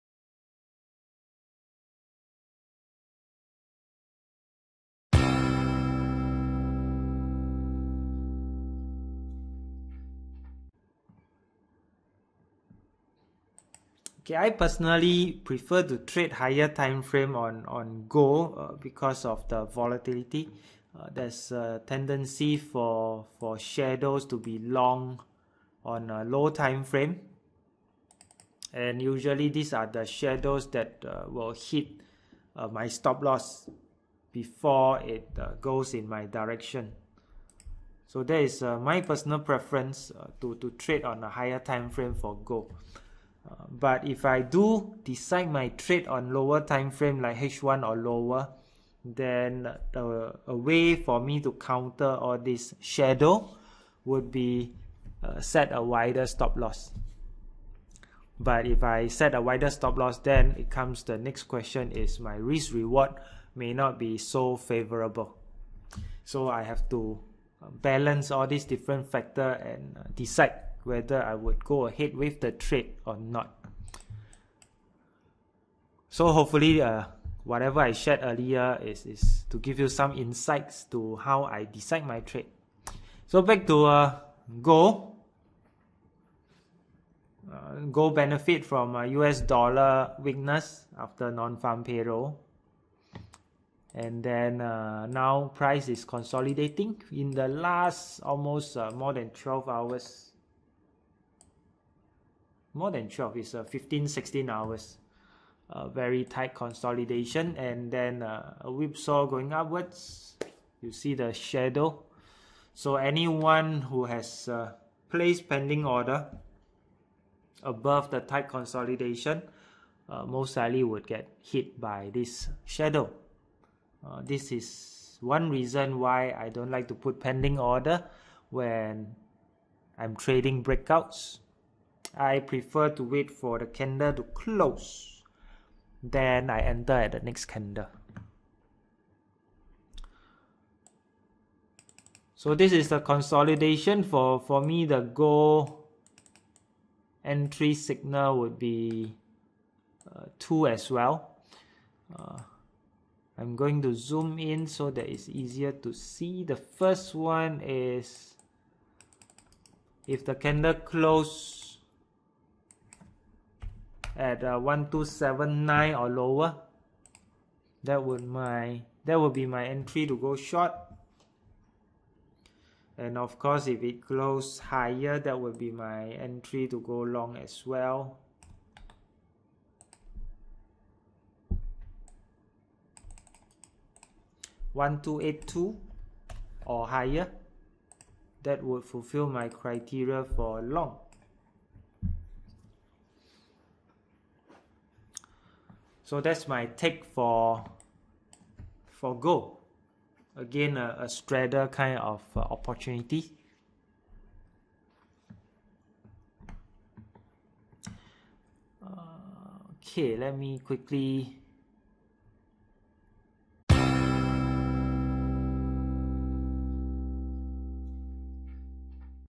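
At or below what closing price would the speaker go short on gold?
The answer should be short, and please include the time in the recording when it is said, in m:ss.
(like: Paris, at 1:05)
1279, at 2:44.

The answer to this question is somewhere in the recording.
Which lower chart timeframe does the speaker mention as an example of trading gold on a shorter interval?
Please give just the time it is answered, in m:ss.
0:47.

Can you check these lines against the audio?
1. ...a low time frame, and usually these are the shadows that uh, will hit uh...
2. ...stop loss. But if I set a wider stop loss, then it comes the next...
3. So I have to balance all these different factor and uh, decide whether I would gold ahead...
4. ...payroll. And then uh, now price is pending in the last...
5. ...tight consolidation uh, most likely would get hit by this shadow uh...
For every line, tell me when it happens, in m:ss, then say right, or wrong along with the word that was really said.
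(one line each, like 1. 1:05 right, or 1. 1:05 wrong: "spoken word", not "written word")
1. 0:26 right
2. 0:56 right
3. 1:06 right
4. 1:31 wrong: "consolidating", not "pending"
5. 1:58 right.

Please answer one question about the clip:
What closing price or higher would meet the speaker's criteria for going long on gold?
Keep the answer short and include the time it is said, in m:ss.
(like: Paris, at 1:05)
1282, at 3:04.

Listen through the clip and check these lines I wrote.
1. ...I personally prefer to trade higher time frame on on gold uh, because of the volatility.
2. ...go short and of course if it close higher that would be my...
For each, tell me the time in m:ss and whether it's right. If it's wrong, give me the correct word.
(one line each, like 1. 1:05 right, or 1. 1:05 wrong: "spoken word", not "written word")
1. 0:14 right
2. 2:50 right.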